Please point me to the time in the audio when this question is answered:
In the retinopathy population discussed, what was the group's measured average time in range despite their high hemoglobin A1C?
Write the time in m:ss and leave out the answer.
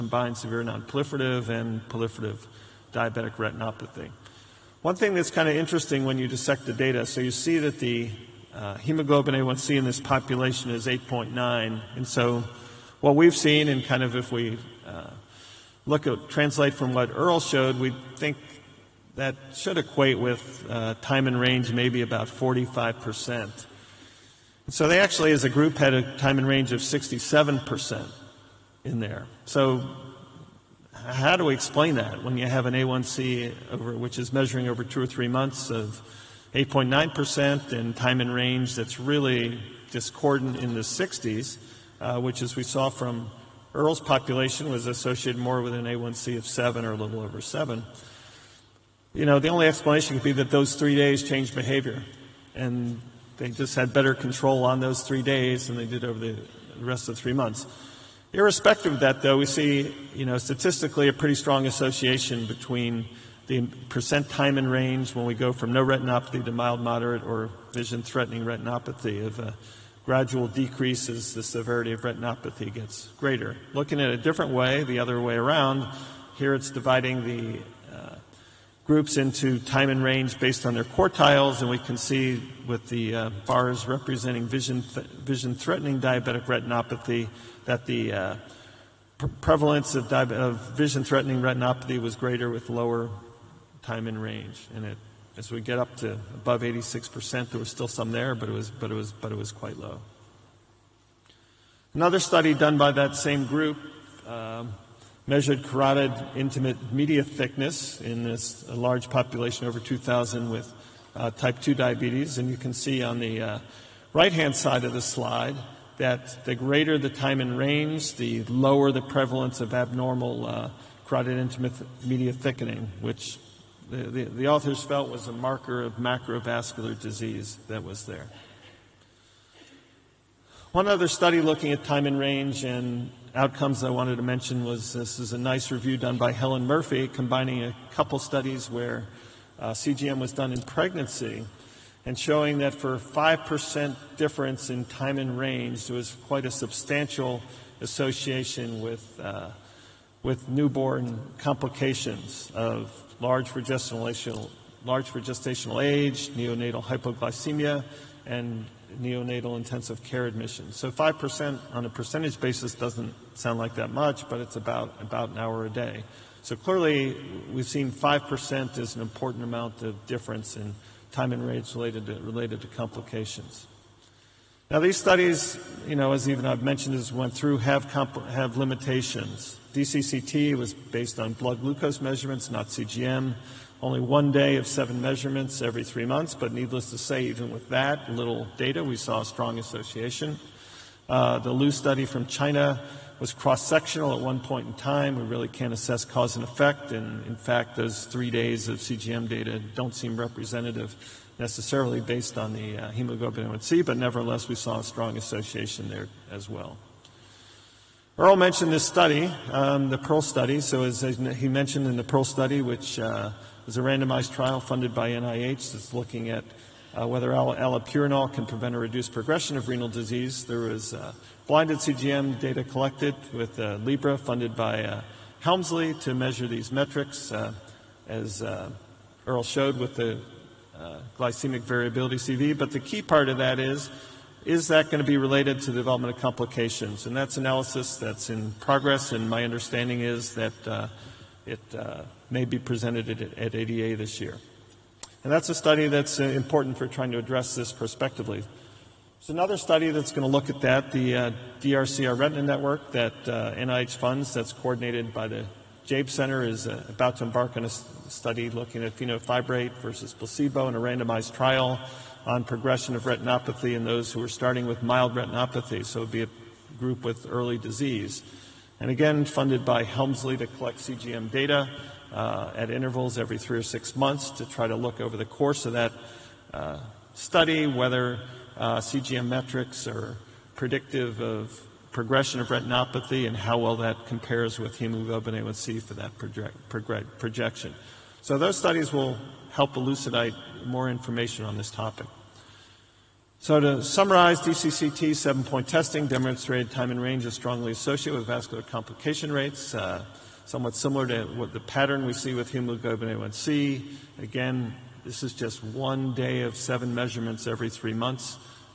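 0:26.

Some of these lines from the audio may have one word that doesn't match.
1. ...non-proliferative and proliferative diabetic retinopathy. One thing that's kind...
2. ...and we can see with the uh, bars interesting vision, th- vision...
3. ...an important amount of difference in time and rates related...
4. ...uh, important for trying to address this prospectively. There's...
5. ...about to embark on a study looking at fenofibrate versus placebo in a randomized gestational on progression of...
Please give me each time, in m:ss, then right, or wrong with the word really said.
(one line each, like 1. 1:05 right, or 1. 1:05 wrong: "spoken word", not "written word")
1. 0:00 right
2. 1:21 wrong: "representing", not "interesting"
3. 2:48 right
4. 4:06 right
5. 4:16 wrong: "trial", not "gestational".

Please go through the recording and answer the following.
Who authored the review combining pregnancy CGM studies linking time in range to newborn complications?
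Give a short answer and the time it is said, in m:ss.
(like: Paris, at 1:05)
Helen Murphy, at 2:16.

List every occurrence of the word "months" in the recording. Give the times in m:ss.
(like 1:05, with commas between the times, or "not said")
0:35, 0:57, 3:06, 4:33, 5:07.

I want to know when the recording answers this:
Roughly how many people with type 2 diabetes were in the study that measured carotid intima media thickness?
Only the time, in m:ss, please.
1:49.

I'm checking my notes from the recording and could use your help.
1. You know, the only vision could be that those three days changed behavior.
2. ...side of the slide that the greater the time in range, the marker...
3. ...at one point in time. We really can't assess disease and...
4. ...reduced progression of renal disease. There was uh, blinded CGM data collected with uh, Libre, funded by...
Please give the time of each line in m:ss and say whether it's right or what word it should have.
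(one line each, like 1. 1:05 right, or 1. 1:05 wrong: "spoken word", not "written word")
1. 0:49 wrong: "explanation", not "vision"
2. 1:54 wrong: "lower", not "marker"
3. 3:14 wrong: "cause", not "disease"
4. 3:38 right.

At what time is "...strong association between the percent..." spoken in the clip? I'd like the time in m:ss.
1:01.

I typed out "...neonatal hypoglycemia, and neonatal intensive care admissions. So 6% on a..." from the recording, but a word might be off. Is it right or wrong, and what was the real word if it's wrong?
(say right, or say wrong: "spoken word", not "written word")
wrong: "5", not "6".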